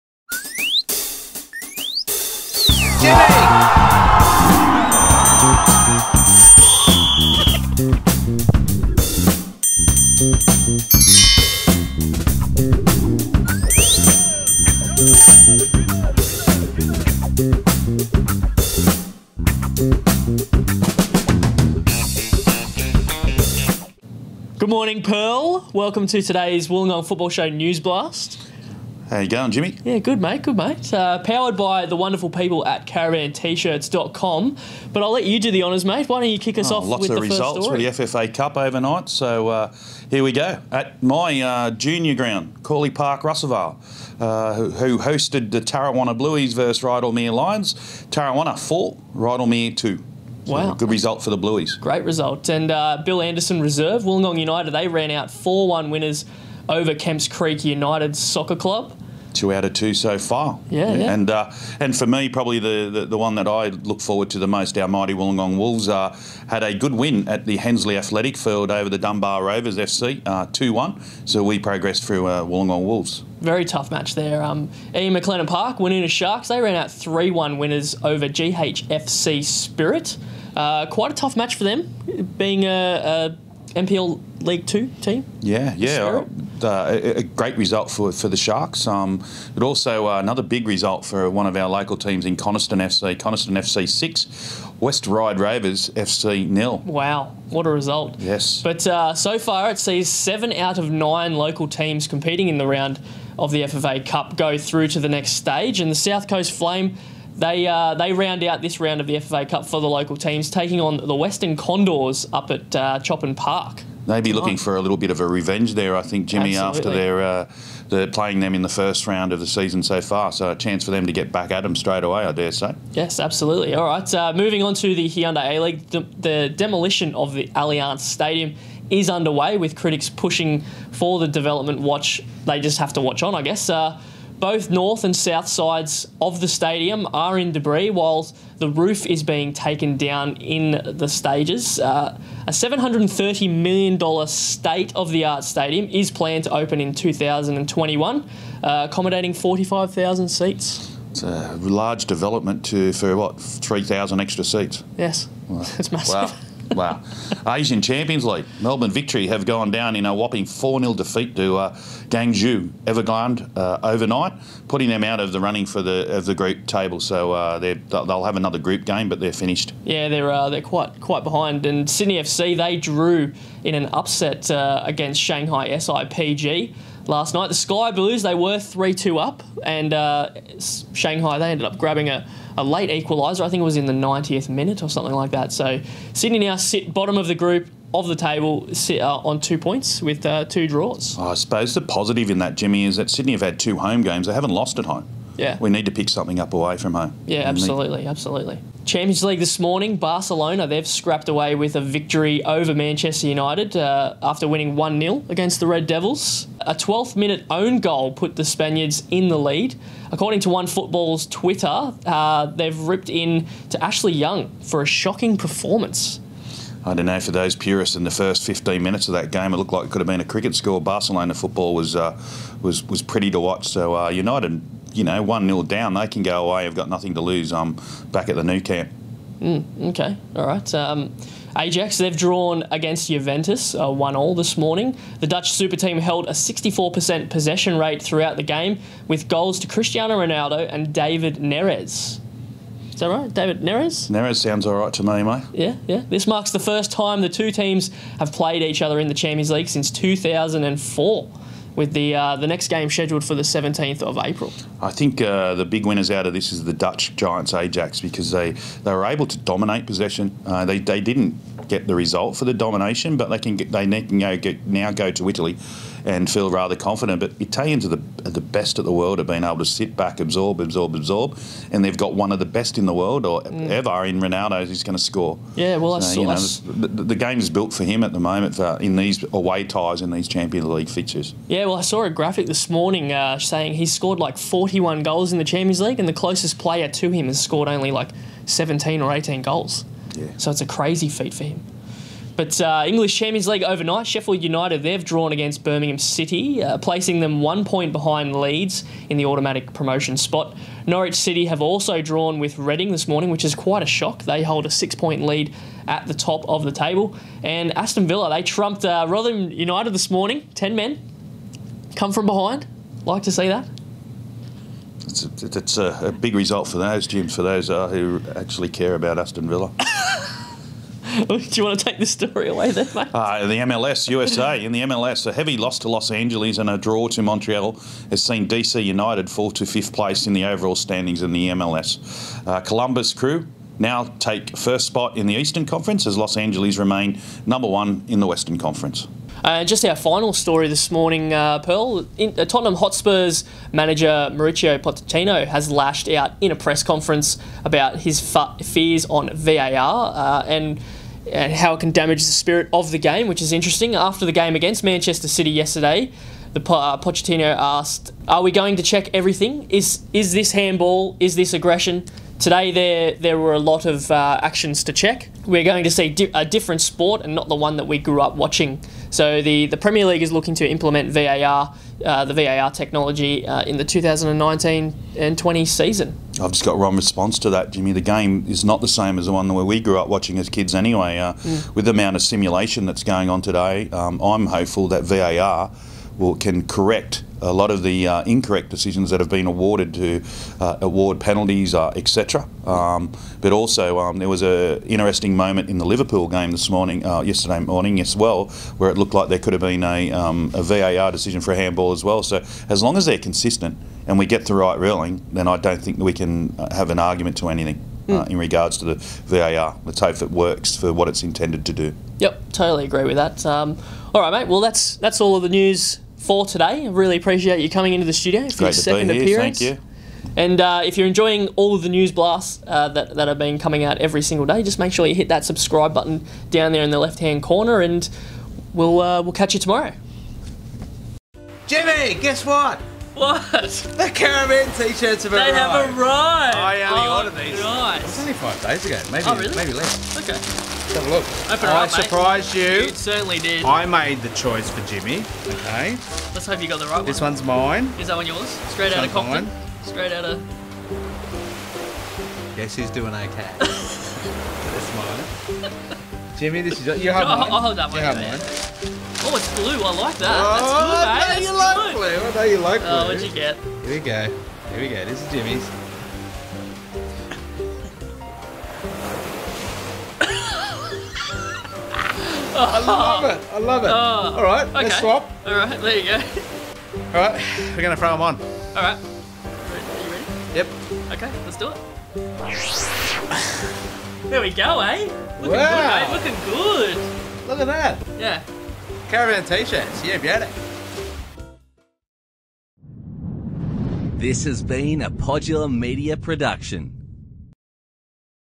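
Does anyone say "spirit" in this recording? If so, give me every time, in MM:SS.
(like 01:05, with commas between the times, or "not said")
01:19, 05:52.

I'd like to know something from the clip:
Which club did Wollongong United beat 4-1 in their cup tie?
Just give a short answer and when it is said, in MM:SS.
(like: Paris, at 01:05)
Kemps Creek United, at 00:56.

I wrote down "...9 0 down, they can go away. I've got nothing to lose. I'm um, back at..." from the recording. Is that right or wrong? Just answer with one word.
wrong.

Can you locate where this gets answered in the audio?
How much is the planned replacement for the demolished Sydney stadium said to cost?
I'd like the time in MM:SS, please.
02:22.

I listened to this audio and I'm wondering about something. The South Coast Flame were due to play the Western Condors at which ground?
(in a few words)
Choppin Park.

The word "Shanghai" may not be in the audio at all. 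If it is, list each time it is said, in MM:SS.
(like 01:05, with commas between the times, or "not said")
02:55, 03:00.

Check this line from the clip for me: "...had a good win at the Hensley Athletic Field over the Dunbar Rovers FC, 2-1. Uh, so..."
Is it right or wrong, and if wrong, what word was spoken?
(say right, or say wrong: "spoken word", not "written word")
right.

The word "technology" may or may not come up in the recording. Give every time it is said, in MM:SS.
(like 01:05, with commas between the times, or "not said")
06:12.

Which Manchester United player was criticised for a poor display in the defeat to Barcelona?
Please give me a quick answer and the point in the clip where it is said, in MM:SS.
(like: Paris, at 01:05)
Ashley Young, at 03:33.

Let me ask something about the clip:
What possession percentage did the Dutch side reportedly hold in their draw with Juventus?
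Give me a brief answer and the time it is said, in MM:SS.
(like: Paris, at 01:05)
64%, at 03:56.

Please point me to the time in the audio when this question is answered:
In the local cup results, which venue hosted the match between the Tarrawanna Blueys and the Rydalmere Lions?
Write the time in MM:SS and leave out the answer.
00:42.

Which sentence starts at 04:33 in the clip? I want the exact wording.
ever in Ronaldo who's going to score.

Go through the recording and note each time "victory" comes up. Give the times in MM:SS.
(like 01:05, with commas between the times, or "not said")
02:38, 03:21.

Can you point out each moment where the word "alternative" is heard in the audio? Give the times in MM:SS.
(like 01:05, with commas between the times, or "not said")
not said.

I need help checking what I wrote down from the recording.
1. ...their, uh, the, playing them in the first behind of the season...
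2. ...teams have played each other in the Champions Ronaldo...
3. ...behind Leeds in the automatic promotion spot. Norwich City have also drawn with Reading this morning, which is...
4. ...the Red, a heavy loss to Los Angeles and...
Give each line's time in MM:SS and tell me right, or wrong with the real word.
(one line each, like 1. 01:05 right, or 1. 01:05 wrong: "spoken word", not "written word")
1. 01:56 wrong: "round", not "behind"
2. 04:07 wrong: "League", not "Ronaldo"
3. 04:57 right
4. 05:24 wrong: "MLS", not "Red".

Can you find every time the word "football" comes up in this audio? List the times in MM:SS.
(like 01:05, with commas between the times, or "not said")
00:27, 03:30, 03:41.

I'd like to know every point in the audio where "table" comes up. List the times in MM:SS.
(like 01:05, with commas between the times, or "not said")
02:46, 03:08, 05:06.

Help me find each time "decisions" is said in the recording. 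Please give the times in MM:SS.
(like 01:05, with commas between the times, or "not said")
06:28, 06:41.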